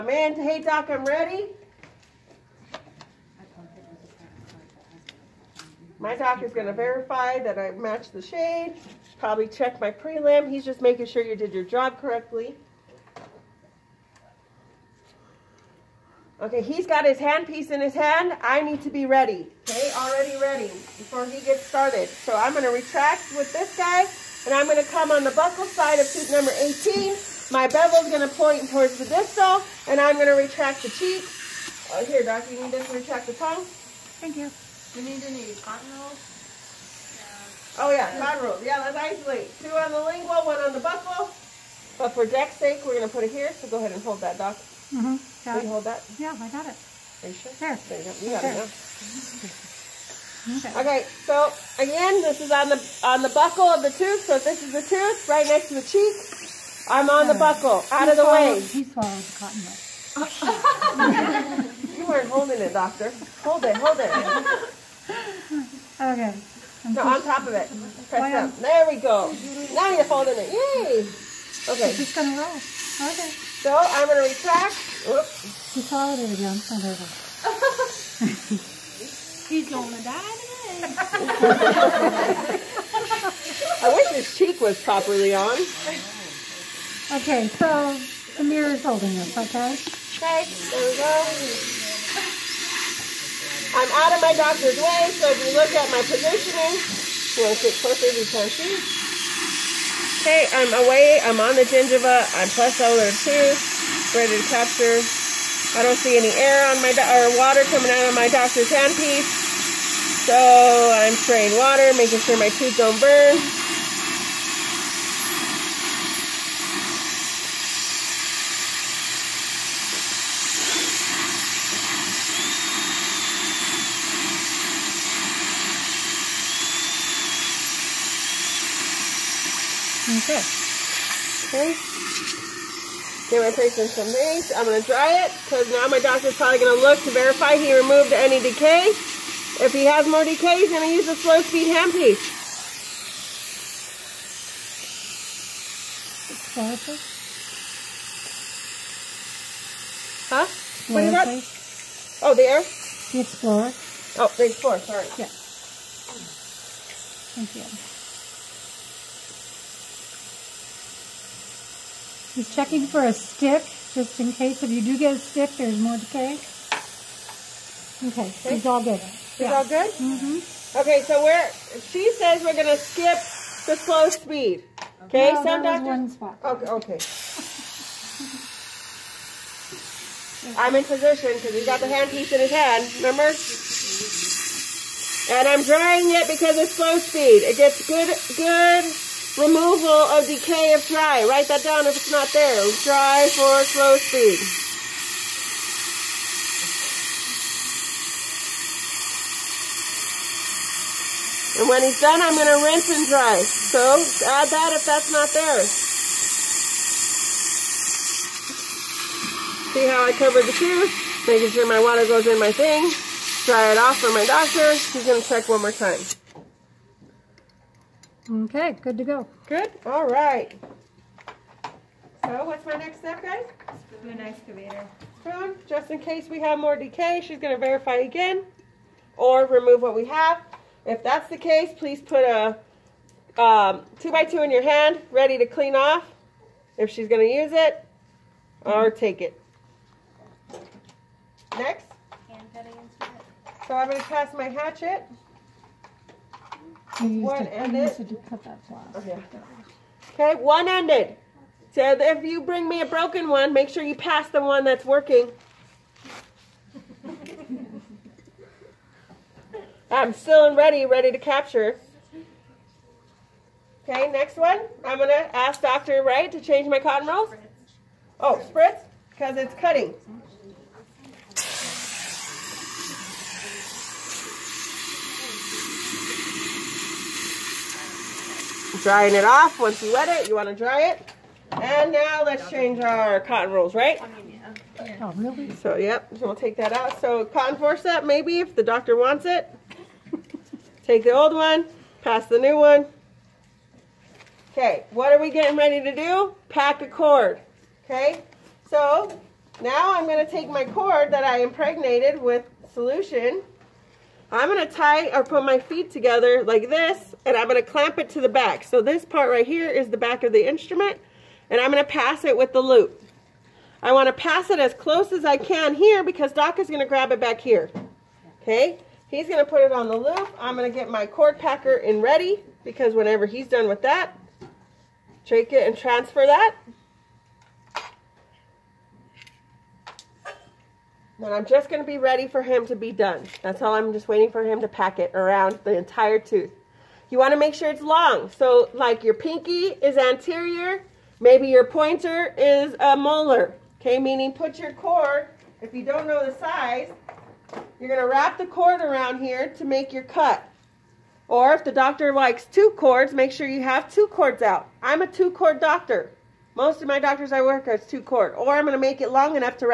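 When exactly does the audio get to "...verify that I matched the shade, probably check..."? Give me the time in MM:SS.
00:06.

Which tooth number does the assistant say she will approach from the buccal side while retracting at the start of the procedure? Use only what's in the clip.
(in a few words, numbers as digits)
18.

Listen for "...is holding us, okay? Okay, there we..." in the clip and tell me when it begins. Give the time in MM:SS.
01:28.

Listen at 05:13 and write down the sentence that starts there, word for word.
I want to pass it as close as I can here because Doc is going to grab it back here.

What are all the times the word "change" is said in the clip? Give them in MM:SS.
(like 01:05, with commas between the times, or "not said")
04:26, 04:42.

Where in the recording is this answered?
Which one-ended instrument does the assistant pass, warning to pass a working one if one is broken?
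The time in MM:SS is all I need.
04:04.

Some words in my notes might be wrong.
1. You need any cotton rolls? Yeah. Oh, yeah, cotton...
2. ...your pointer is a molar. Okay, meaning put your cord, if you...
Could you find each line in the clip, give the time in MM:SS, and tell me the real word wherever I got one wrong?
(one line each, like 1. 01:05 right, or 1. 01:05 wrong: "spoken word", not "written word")
1. 00:34 right
2. 05:41 right.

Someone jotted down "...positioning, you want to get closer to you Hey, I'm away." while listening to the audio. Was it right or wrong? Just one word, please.
right.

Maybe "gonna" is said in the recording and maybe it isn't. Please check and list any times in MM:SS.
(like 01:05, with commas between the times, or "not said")
01:12.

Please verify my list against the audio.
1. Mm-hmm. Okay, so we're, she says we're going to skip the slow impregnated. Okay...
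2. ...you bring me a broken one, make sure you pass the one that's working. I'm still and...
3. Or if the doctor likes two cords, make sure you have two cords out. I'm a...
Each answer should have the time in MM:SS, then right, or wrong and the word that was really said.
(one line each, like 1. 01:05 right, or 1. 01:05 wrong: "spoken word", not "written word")
1. 02:49 wrong: "speed", not "impregnated"
2. 04:12 right
3. 05:51 right.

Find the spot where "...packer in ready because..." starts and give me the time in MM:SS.
05:21.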